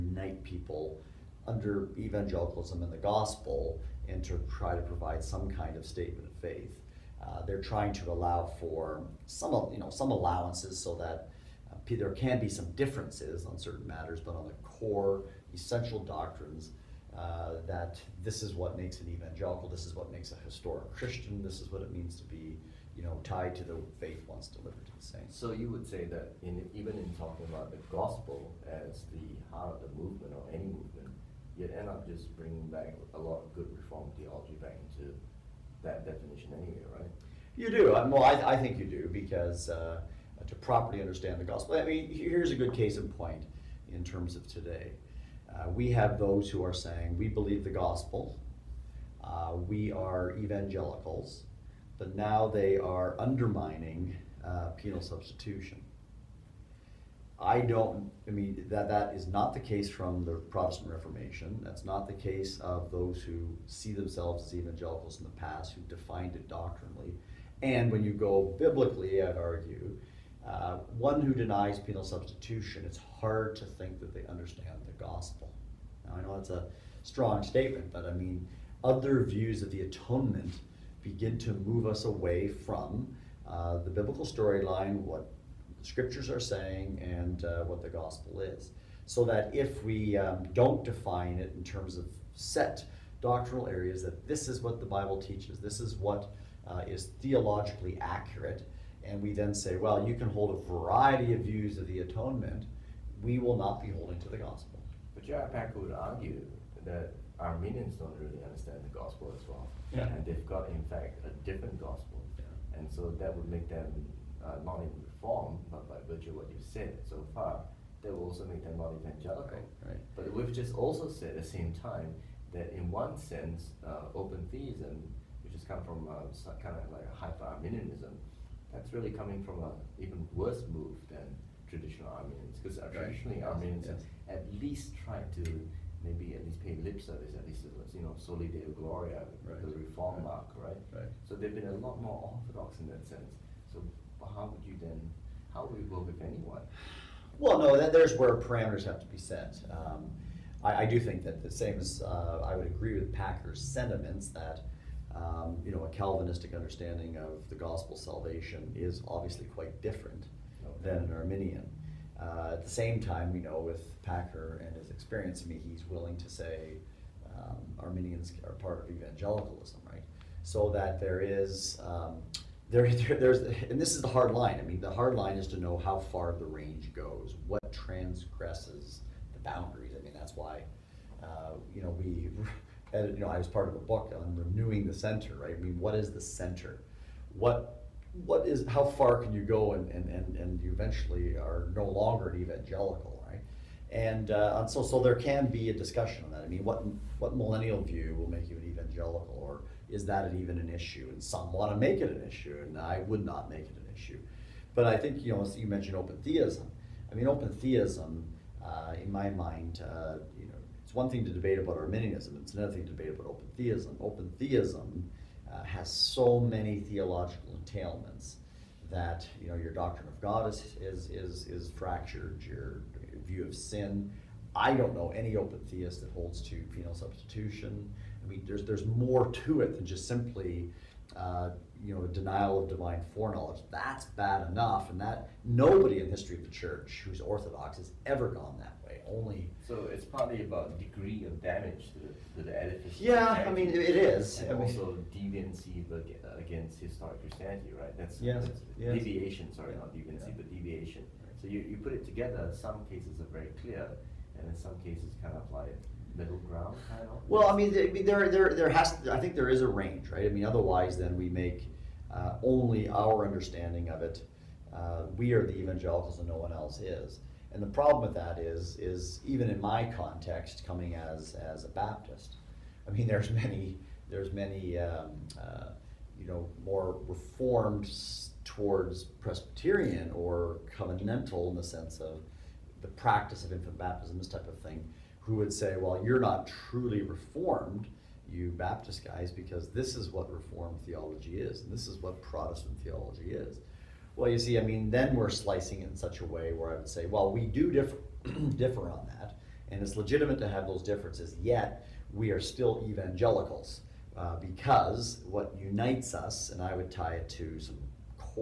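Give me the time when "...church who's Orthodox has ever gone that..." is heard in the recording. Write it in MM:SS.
03:56.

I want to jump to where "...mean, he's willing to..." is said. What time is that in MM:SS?
02:45.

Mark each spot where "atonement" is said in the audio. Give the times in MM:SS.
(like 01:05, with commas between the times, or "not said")
01:19, 01:41.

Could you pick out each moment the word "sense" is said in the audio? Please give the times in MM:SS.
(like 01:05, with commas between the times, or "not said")
02:03, 02:23, 04:41.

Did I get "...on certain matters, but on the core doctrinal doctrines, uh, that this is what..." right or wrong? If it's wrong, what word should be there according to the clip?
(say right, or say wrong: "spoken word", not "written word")
wrong: "essential", not "doctrinal".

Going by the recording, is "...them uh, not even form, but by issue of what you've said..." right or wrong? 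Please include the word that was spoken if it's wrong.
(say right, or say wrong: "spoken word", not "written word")
wrong: "virtue", not "issue".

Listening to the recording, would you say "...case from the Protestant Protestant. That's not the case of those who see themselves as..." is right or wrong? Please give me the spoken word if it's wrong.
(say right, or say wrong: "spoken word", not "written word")
wrong: "Reformation", not "Protestant".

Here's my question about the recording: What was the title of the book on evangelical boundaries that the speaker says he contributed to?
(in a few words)
Renewing the center.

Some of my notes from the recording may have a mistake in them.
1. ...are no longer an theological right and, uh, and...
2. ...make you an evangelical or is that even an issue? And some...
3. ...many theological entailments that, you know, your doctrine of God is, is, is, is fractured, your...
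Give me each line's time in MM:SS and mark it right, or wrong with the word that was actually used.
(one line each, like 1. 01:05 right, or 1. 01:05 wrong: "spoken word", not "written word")
1. 03:11 wrong: "evangelical", not "theological"
2. 03:18 right
3. 03:36 right.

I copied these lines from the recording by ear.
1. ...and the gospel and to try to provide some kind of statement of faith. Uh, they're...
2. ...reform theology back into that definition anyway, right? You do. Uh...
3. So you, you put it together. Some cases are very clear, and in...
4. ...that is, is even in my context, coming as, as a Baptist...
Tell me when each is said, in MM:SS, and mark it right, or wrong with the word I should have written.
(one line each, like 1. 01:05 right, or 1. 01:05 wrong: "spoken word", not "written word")
1. 00:02 right
2. 00:33 right
3. 04:11 right
4. 04:28 right.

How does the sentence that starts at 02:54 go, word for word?
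I mean, the hard line is to know how far the range goes, what transgresses the boundaries.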